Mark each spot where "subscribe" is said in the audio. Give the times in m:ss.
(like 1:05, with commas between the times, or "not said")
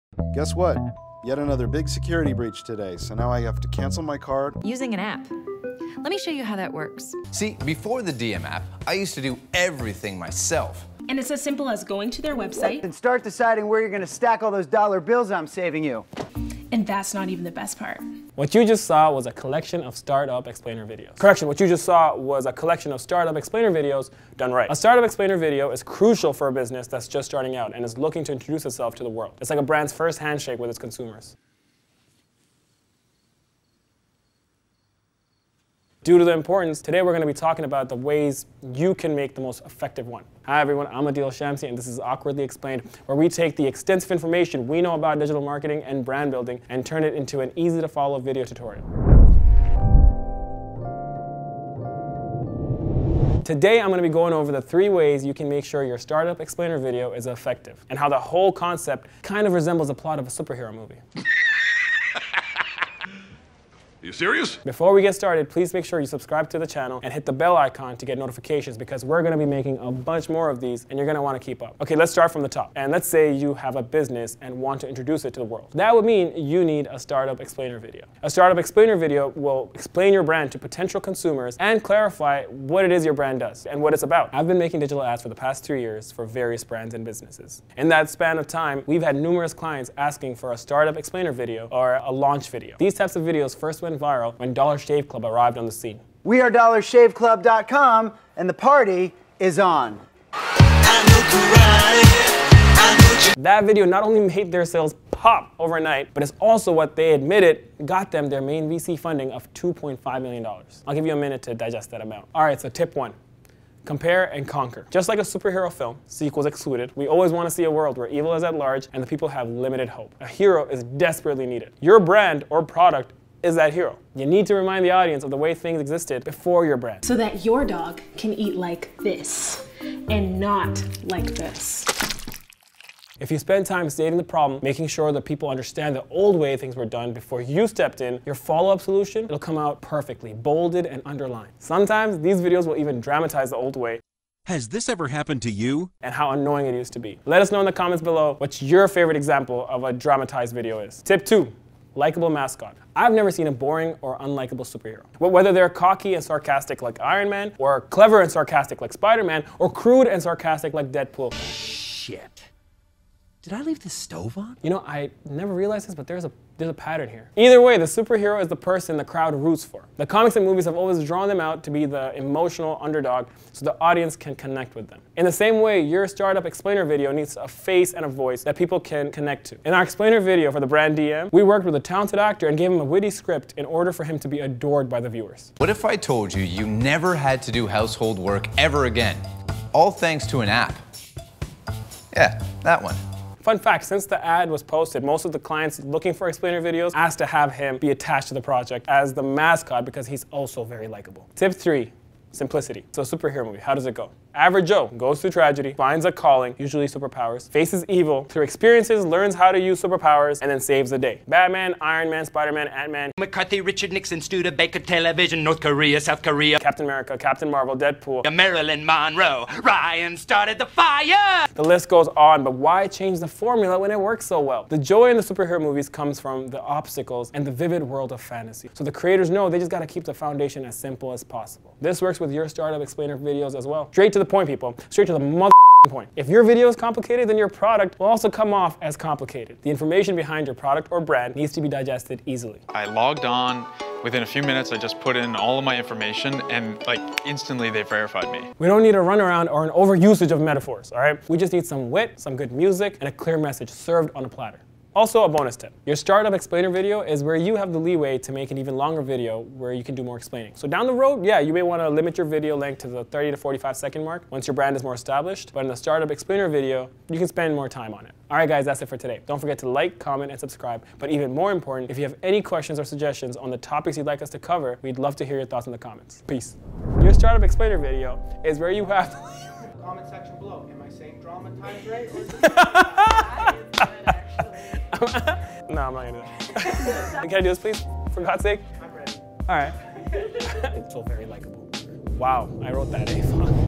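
1:06, 4:30.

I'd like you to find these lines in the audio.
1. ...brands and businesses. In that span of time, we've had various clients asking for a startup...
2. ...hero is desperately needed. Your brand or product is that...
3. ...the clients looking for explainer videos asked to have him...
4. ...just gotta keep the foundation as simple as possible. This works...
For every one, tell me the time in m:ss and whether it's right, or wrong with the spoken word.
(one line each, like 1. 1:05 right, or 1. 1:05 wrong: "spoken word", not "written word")
1. 1:26 wrong: "numerous", not "various"
2. 2:00 right
3. 3:15 right
4. 3:49 right.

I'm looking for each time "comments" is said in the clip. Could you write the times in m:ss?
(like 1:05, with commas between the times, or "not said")
2:27, 4:29, 4:35, 4:39.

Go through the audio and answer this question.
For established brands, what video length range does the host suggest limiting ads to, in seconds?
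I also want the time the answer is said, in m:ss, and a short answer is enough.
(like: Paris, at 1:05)
30 to 45 seconds, at 4:23.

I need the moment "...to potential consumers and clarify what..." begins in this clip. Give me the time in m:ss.
1:20.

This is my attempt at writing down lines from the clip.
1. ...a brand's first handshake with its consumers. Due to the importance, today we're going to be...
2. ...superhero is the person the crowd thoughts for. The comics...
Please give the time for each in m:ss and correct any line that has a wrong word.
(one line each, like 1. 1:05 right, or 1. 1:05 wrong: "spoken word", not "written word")
1. 0:29 right
2. 2:47 wrong: "roots", not "thoughts".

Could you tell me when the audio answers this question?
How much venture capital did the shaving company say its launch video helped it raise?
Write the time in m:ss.
1:49.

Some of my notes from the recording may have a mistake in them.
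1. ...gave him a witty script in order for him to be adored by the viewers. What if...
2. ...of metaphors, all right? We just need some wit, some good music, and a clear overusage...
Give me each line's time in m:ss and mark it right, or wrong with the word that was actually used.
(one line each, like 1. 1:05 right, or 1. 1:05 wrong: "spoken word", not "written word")
1. 3:02 right
2. 4:10 wrong: "message", not "overusage".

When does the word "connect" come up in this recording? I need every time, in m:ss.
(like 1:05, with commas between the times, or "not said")
2:54, 2:59.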